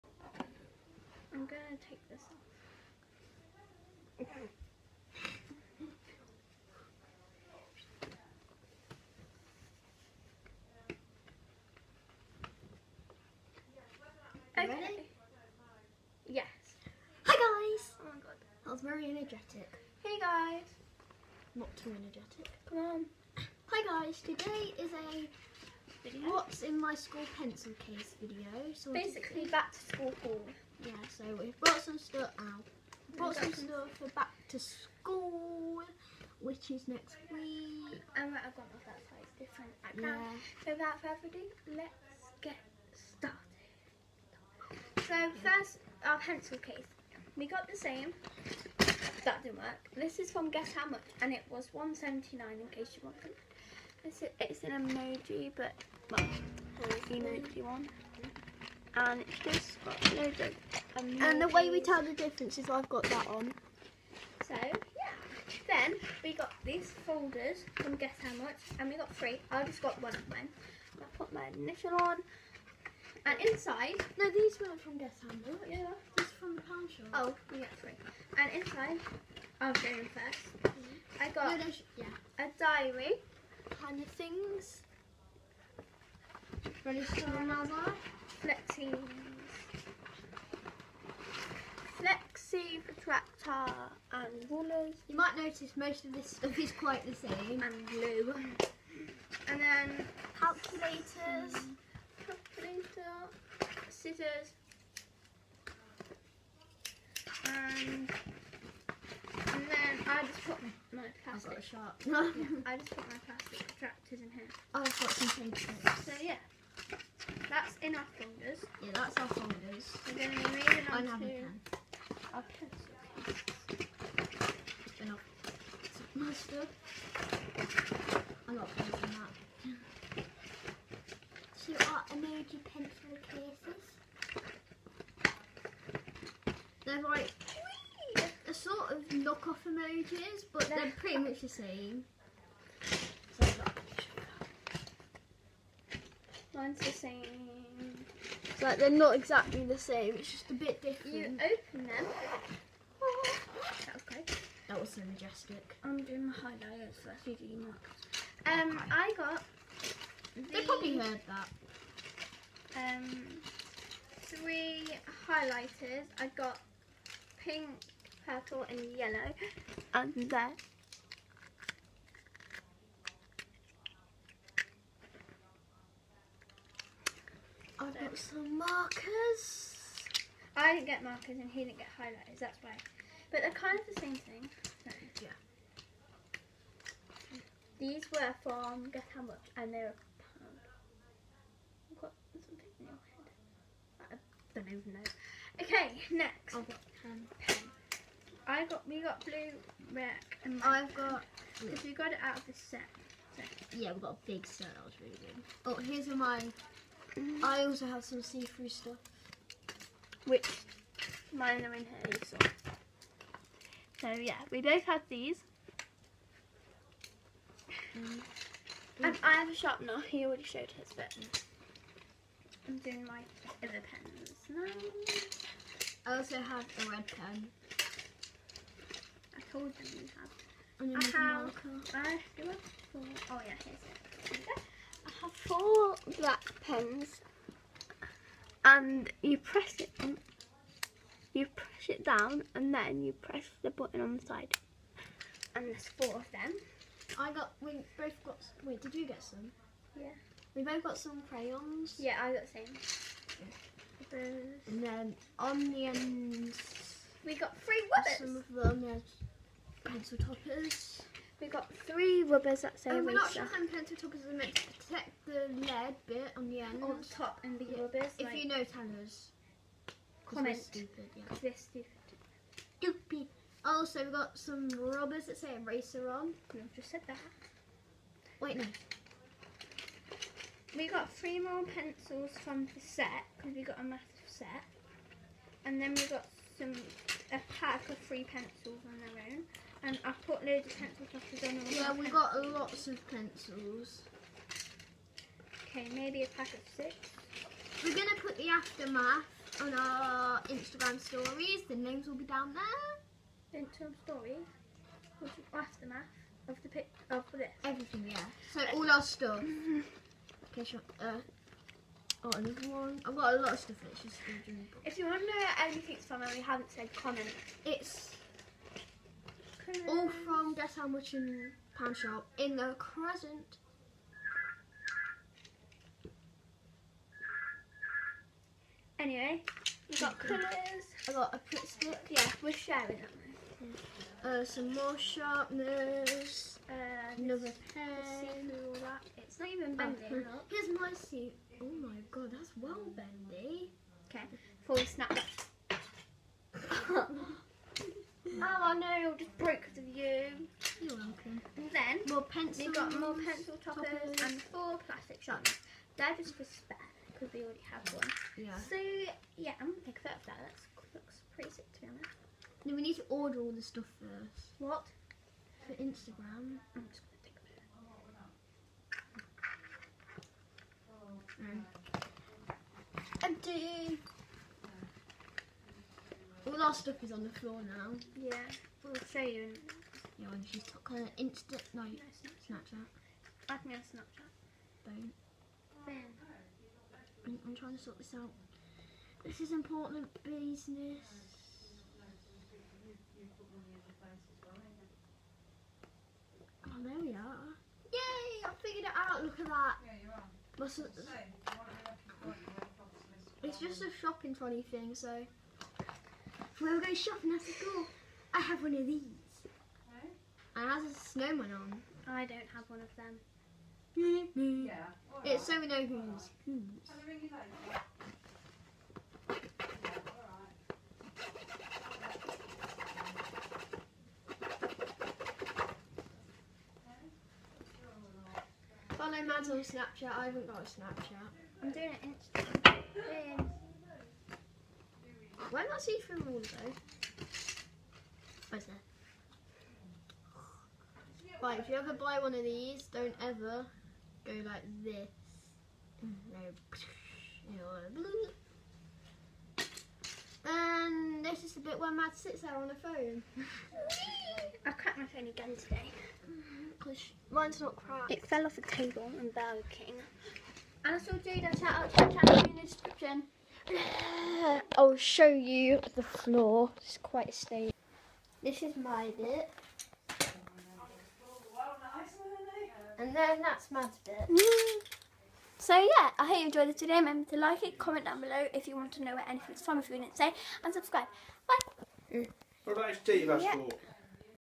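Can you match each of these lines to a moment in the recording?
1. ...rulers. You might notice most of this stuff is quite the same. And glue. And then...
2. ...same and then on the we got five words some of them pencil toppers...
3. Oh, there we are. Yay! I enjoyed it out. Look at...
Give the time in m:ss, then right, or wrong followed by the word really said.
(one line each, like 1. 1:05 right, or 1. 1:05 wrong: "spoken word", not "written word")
1. 1:34 right
2. 4:12 wrong: "three", not "five"
3. 6:36 wrong: "figured", not "enjoyed".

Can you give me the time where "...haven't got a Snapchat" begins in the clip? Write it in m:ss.
7:10.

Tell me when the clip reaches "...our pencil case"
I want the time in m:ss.
0:46.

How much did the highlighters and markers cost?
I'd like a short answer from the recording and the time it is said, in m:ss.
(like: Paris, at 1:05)
a pound, at 3:09.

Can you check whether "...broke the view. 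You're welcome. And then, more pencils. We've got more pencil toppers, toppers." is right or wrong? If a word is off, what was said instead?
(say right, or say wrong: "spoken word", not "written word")
right.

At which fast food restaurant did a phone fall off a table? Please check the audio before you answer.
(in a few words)
Burger King.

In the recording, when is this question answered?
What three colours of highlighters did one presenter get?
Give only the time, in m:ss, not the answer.
2:47.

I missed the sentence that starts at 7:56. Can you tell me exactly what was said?
Remember to like it, comment down below if you want to know where anything's from if you didn't say, and subscribe.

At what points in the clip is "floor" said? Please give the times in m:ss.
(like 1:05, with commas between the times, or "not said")
6:17, 7:46.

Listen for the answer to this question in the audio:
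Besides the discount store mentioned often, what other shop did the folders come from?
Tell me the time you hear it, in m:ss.
1:16.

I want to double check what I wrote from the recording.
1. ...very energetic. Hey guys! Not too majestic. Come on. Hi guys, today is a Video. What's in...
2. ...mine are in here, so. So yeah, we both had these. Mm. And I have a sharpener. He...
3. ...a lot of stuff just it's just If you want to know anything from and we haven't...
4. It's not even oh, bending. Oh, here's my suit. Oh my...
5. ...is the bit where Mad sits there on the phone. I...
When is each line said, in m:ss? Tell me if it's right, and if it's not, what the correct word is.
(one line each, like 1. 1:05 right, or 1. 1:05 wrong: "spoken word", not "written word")
1. 0:18 wrong: "energetic", not "majestic"
2. 3:31 right
3. 5:13 right
4. 5:39 right
5. 7:31 right.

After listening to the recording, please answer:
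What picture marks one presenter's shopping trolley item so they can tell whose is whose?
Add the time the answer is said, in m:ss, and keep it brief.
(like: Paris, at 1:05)
a snowman, at 6:50.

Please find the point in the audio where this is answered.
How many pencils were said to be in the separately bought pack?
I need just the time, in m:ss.
4:56.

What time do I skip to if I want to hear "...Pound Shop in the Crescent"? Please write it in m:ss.
5:21.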